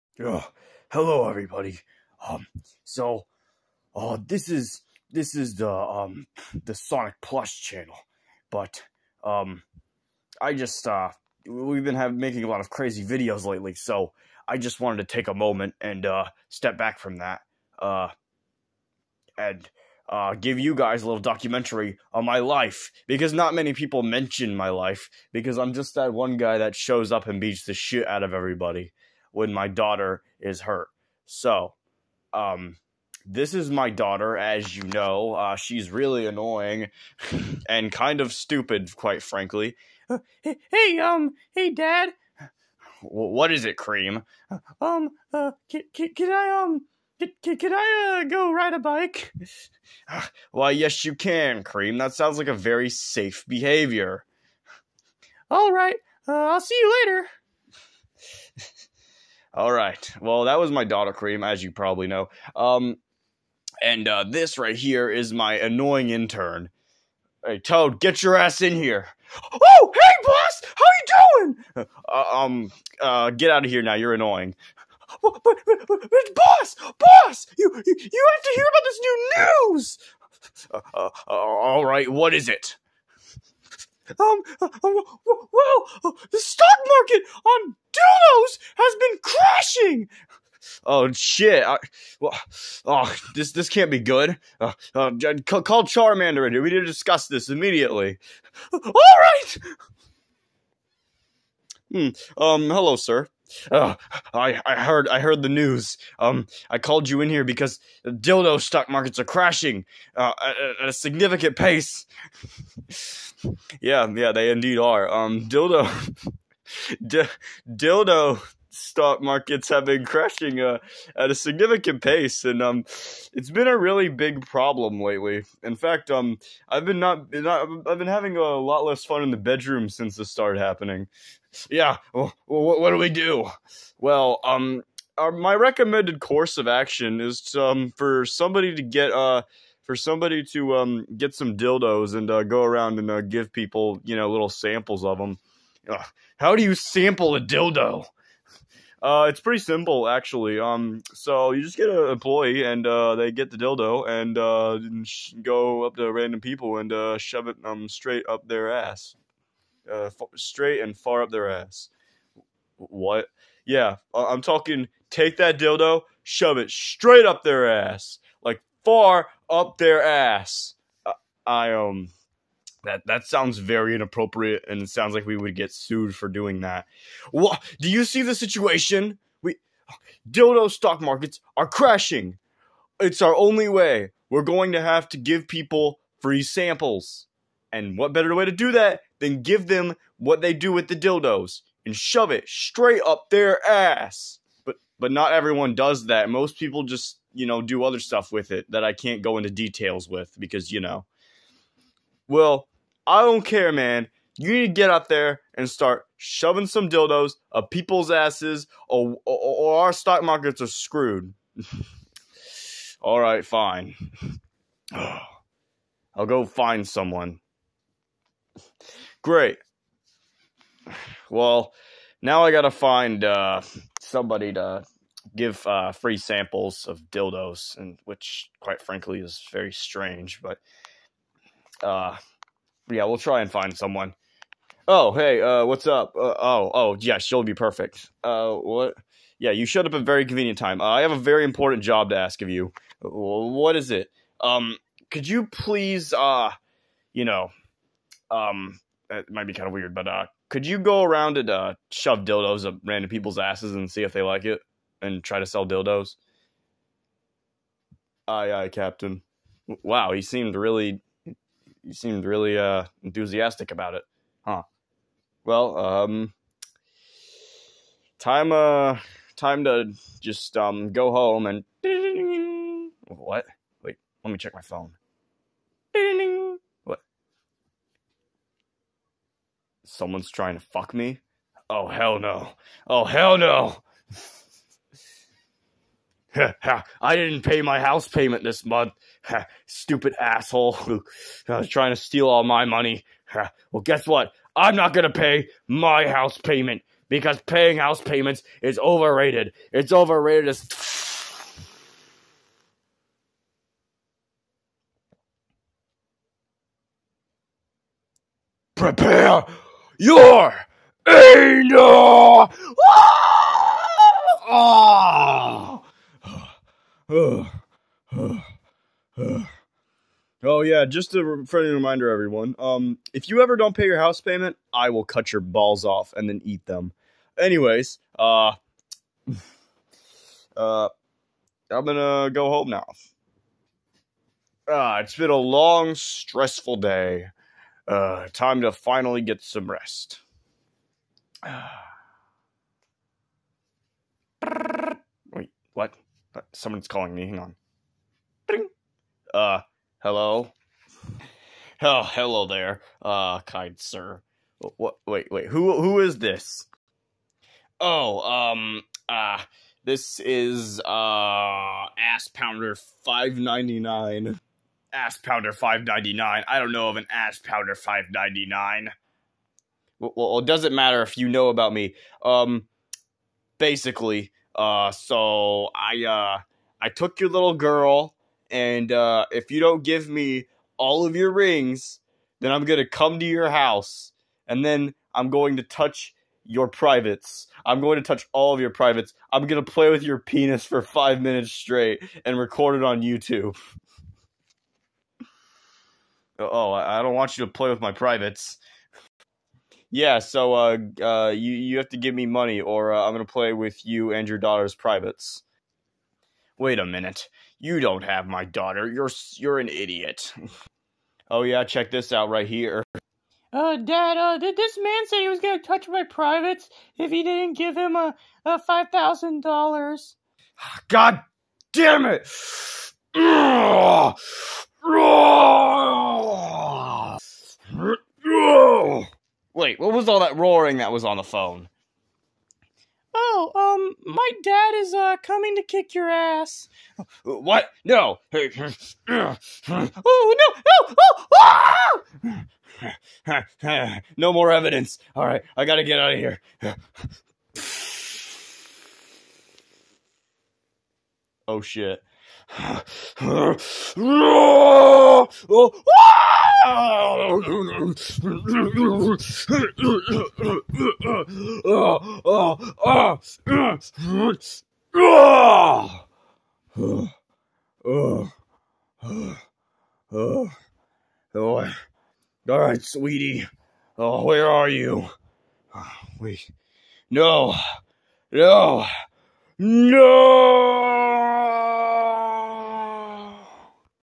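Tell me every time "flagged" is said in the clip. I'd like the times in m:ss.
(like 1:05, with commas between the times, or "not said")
not said.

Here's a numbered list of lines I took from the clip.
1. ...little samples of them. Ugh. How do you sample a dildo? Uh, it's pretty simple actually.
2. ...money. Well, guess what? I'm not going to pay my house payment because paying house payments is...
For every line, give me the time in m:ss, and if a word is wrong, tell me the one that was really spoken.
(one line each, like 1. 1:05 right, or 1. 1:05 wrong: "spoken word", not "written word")
1. 2:24 right
2. 4:52 right.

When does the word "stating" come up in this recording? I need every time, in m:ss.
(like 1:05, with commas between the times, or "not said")
not said.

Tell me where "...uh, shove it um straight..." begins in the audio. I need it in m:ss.
2:36.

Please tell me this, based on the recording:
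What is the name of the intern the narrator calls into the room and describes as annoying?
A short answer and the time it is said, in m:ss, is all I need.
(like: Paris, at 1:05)
Toad, at 1:07.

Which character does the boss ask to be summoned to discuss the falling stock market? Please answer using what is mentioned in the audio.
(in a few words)
Charmander.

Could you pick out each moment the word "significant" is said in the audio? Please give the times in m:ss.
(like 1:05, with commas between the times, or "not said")
1:50, 2:01.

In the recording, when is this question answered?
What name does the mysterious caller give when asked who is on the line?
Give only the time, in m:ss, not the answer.
6:01.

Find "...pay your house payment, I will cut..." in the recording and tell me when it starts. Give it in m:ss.
5:23.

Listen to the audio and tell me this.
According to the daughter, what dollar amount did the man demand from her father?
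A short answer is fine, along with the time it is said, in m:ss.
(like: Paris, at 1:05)
$5,000, at 6:58.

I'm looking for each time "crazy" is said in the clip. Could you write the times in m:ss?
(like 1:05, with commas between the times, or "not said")
0:12.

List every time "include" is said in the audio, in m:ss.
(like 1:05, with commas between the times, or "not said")
not said.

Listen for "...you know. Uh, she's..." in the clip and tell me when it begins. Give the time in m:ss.
0:34.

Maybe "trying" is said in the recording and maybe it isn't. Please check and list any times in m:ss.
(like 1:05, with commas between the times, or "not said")
4:40, 4:51.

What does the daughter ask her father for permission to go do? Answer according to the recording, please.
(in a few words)
Ride a bike.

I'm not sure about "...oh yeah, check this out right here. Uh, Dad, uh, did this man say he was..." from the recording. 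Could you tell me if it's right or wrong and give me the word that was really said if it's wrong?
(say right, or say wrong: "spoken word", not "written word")
right.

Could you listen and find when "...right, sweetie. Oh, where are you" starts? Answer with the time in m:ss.
7:52.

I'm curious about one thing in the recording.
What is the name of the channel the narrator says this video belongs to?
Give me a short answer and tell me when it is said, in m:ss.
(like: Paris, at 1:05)
Sonic Plush, at 0:06.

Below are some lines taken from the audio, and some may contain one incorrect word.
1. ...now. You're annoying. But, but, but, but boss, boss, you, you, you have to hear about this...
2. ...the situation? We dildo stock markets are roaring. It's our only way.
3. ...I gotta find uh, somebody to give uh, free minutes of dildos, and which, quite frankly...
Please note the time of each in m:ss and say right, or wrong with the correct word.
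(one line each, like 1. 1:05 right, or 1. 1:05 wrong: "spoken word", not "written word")
1. 1:13 right
2. 2:58 wrong: "crashing", not "roaring"
3. 3:42 wrong: "samples", not "minutes".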